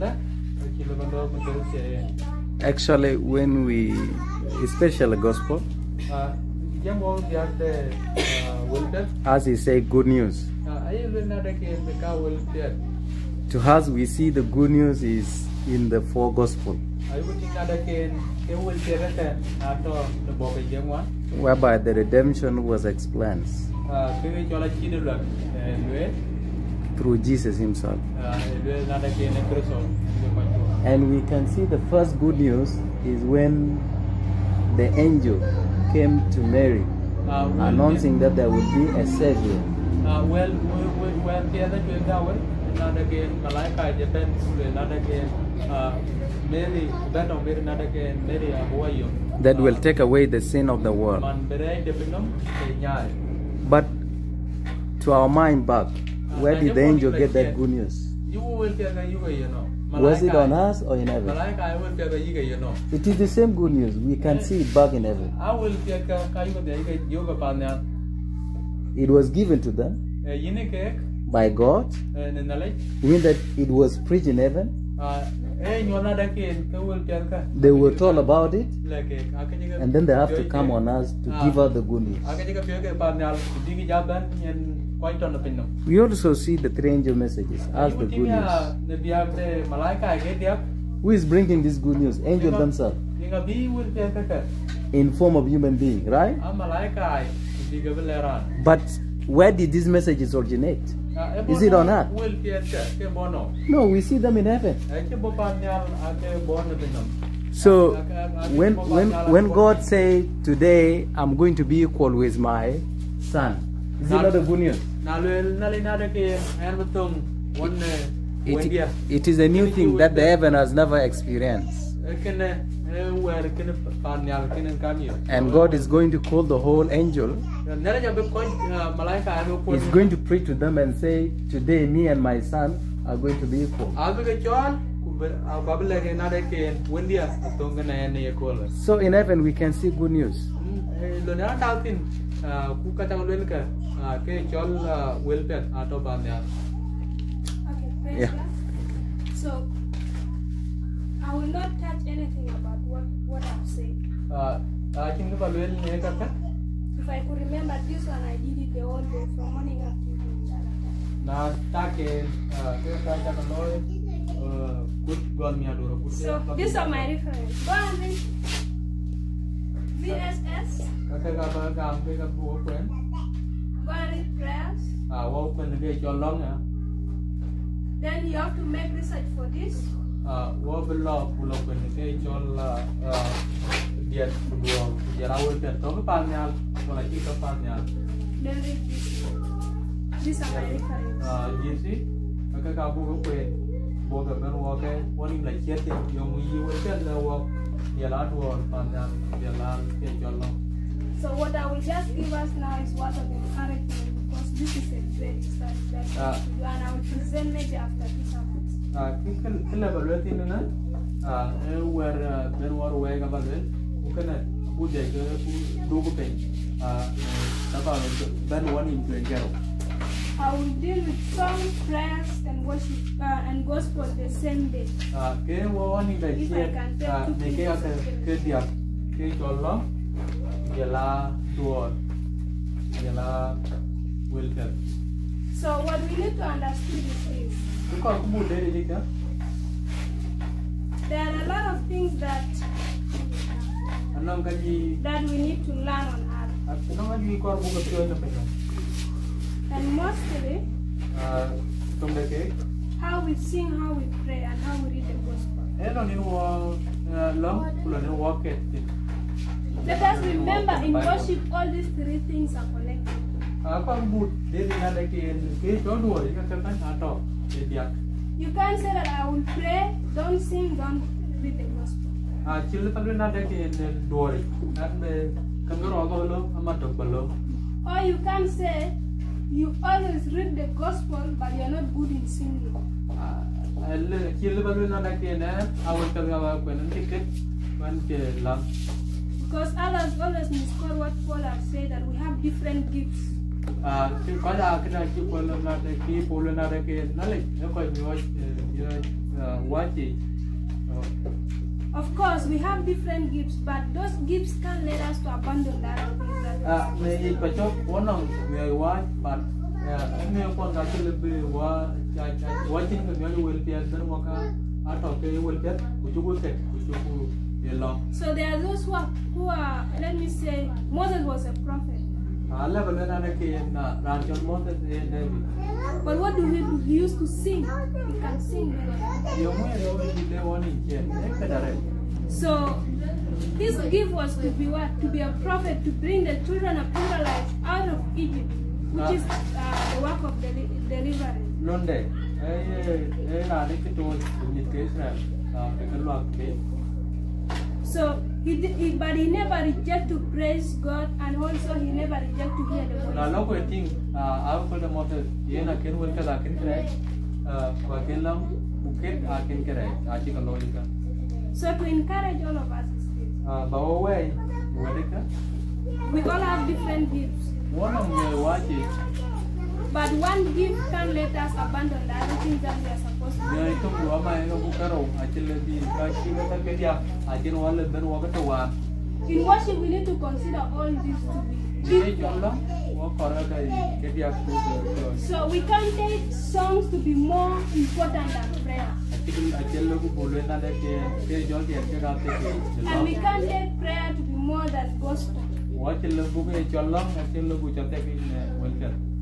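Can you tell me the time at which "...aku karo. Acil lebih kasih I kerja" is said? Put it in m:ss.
6:14.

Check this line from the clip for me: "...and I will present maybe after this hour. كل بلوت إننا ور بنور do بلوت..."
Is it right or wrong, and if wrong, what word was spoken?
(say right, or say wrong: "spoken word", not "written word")
right.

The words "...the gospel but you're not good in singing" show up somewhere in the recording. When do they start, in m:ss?
4:40.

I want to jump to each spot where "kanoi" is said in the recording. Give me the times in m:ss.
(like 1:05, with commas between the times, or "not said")
2:43.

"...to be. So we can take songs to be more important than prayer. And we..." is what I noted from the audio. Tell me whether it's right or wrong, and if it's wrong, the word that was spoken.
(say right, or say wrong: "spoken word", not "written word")
right.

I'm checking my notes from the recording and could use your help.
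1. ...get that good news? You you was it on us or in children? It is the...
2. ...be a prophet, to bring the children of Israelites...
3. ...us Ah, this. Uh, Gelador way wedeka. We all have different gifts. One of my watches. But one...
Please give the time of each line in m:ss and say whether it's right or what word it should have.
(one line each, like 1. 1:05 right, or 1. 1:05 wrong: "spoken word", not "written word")
1. 0:57 wrong: "heaven", not "children"
2. 5:35 right
3. 6:02 wrong: "Bawo", not "Gelador".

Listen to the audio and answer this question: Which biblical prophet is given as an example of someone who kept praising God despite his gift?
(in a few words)
Moses.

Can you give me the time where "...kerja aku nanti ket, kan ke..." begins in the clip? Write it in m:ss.
4:46.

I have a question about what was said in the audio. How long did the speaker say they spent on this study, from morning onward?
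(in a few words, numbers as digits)
The whole day.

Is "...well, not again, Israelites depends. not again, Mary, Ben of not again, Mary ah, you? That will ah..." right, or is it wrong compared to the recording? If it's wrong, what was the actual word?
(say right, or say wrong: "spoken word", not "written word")
wrong: "Malaika", not "Israelites".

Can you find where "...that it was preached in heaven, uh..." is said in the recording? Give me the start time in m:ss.
1:13.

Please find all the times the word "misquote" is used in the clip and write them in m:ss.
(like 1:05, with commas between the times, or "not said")
4:50.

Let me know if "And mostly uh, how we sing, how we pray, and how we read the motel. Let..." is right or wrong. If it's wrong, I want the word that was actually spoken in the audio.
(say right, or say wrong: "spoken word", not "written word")
wrong: "gospel", not "motel".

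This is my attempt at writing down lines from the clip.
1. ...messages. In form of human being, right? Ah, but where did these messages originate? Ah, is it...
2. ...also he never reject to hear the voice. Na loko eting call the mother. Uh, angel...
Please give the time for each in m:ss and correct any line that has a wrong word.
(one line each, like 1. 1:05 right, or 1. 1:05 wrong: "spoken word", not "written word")
1. 1:32 wrong: "themselves", not "messages"
2. 5:51 wrong: "motel", not "angel".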